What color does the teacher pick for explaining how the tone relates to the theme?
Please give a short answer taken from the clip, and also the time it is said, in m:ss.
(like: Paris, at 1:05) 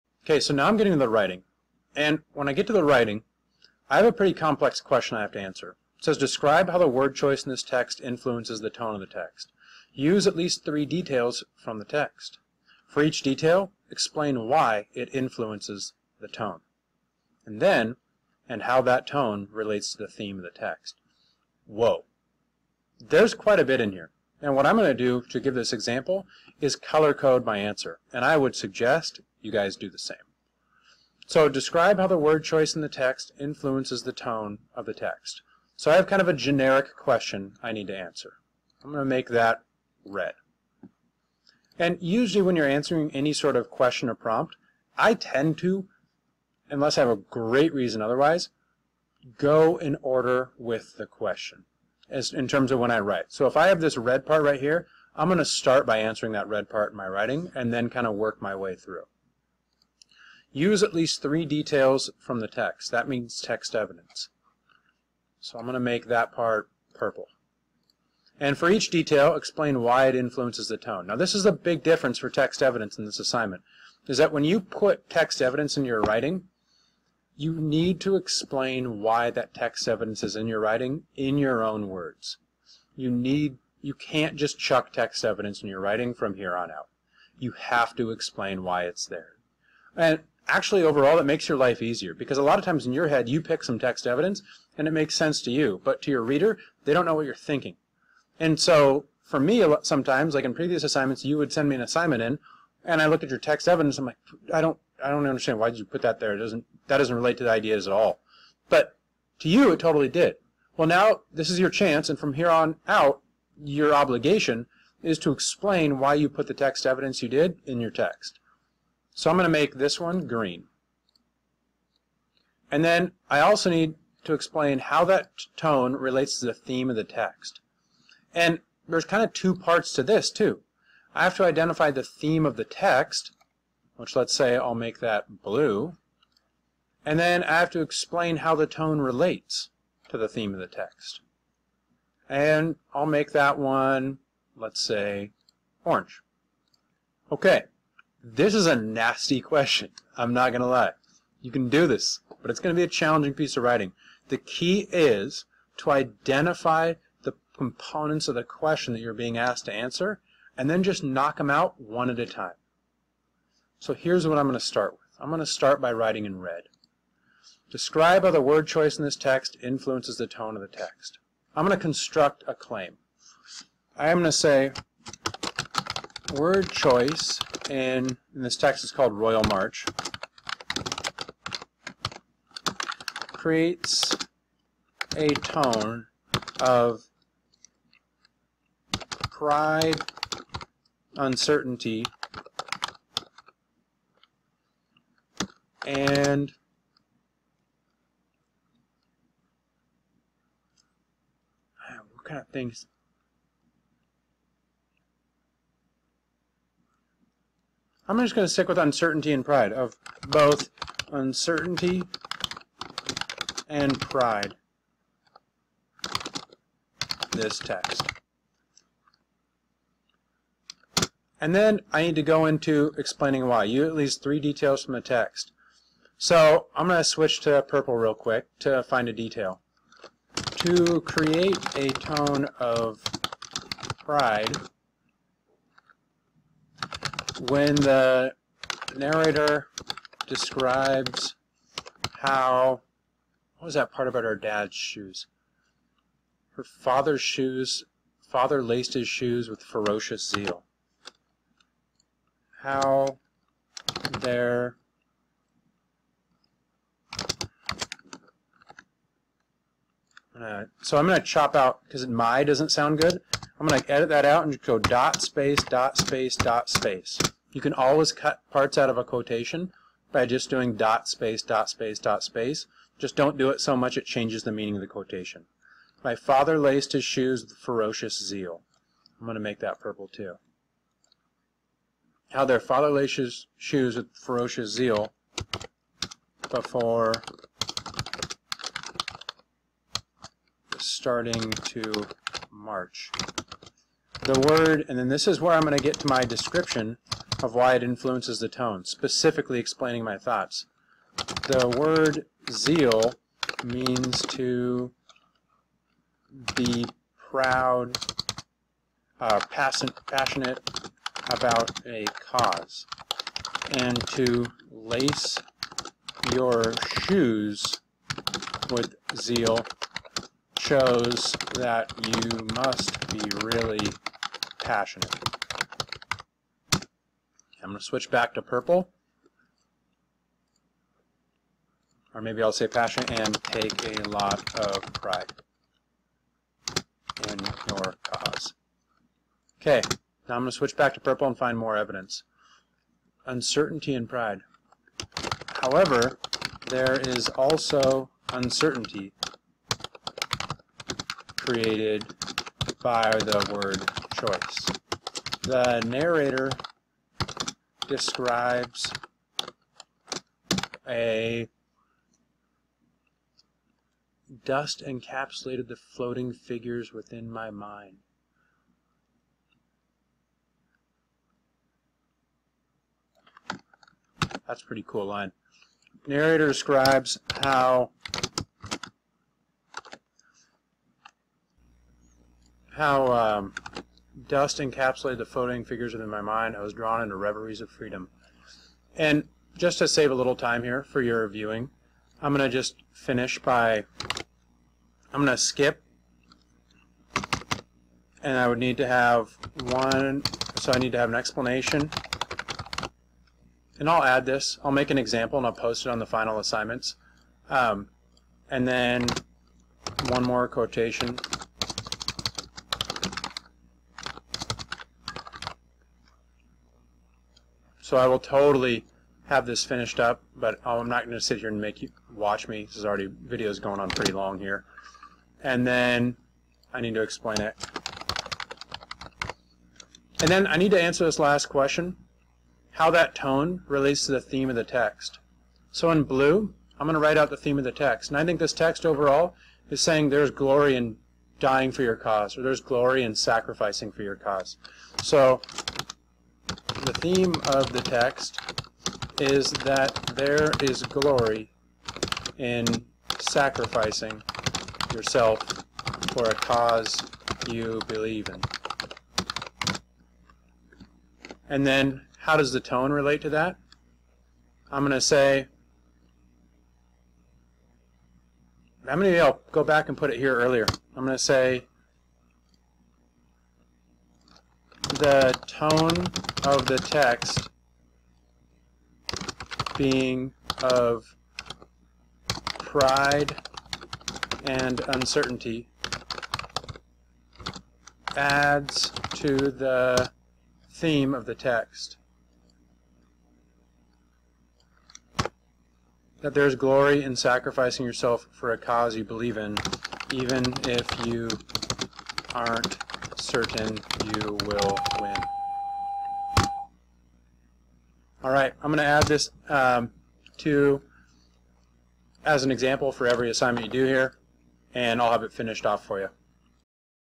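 orange, at 2:22.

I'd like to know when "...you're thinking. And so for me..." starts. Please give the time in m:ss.
1:37.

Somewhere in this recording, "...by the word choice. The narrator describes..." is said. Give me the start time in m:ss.
5:52.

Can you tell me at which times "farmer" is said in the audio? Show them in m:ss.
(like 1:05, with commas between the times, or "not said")
not said.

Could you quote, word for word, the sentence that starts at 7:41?
And then, how does the tone relate to that?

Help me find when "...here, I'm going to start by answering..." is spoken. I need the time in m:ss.
0:54.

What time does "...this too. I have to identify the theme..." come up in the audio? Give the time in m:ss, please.
2:10.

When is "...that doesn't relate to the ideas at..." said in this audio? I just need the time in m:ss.
1:46.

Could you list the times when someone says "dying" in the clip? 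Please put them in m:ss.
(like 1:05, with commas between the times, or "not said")
7:21.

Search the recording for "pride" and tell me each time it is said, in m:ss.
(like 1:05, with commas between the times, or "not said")
3:09, 3:29, 3:34, 3:54, 5:34, 5:44, 8:02.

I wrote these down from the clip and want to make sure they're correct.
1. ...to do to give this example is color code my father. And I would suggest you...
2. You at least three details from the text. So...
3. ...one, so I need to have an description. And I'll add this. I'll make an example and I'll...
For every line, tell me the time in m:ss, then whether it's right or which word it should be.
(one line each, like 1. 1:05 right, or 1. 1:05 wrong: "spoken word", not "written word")
1. 0:24 wrong: "answer", not "father"
2. 3:43 right
3. 6:39 wrong: "explanation", not "description".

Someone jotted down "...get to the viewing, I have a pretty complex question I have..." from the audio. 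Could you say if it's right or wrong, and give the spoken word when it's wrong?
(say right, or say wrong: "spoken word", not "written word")
wrong: "writing", not "viewing".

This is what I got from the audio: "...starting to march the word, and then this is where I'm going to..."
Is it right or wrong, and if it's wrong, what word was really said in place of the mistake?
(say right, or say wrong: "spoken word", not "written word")
right.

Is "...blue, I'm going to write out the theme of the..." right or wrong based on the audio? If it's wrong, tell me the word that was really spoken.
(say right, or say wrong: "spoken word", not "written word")
right.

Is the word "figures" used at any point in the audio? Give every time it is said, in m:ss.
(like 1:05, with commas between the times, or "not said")
6:06, 6:25.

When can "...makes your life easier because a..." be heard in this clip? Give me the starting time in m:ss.
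1:31.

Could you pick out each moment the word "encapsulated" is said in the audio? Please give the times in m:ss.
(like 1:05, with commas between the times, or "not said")
6:04, 6:24.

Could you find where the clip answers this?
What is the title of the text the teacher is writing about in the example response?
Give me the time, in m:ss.
2:58.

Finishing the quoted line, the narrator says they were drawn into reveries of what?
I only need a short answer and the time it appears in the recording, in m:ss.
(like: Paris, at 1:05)
freedom, at 6:27.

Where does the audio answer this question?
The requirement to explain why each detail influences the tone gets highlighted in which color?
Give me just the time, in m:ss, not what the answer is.
1:59.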